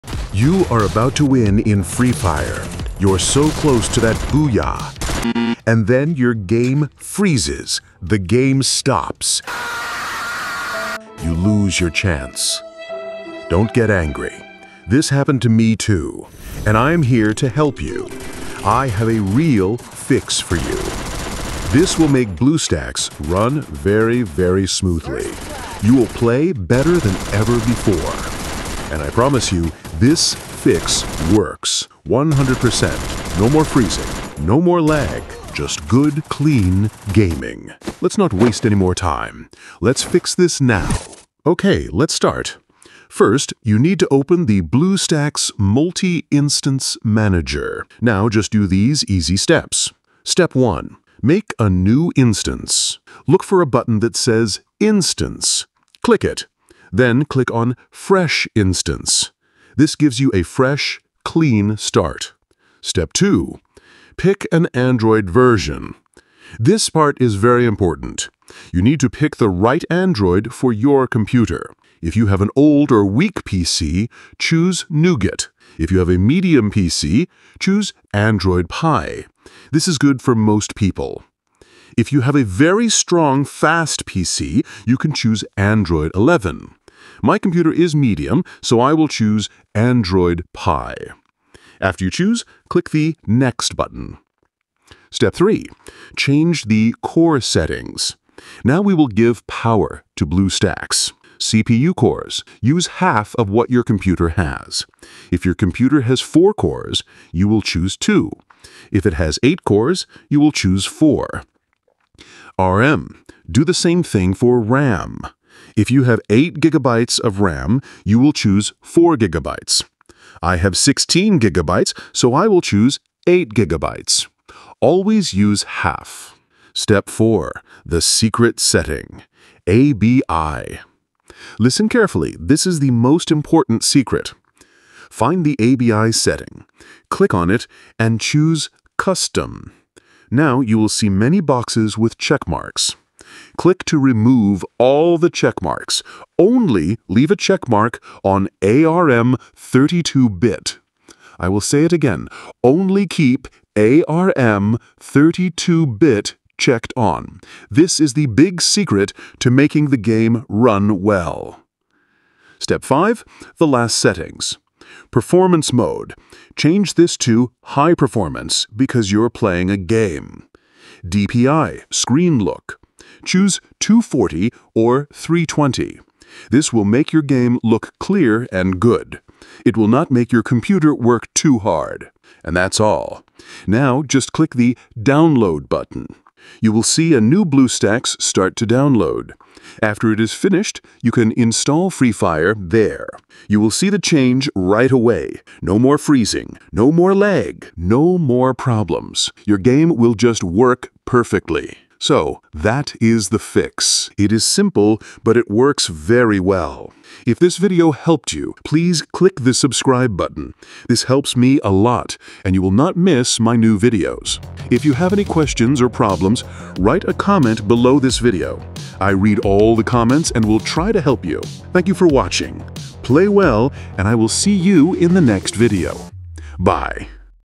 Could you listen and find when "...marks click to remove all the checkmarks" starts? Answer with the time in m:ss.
2:22.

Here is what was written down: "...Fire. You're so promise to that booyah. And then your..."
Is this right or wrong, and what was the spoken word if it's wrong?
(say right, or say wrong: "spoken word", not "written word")
wrong: "close", not "promise".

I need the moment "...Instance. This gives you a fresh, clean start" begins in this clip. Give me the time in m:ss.
0:58.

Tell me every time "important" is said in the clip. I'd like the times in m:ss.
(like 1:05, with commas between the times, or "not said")
1:07, 2:13.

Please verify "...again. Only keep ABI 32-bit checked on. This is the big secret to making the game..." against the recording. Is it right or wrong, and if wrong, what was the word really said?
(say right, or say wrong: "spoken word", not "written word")
wrong: "ARM", not "ABI".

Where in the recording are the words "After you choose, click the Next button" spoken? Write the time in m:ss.
1:31.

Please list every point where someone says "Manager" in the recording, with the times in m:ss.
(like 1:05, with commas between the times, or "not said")
0:47.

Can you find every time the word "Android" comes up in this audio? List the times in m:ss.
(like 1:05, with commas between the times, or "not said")
1:04, 1:09, 1:18, 1:25, 1:29.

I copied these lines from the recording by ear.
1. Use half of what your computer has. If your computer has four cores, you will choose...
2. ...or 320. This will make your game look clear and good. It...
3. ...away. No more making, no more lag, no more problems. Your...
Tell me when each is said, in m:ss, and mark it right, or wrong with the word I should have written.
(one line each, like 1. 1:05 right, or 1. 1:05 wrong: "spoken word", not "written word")
1. 1:42 right
2. 2:54 right
3. 3:14 wrong: "freezing", not "making".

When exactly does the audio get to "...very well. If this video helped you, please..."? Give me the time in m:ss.
3:25.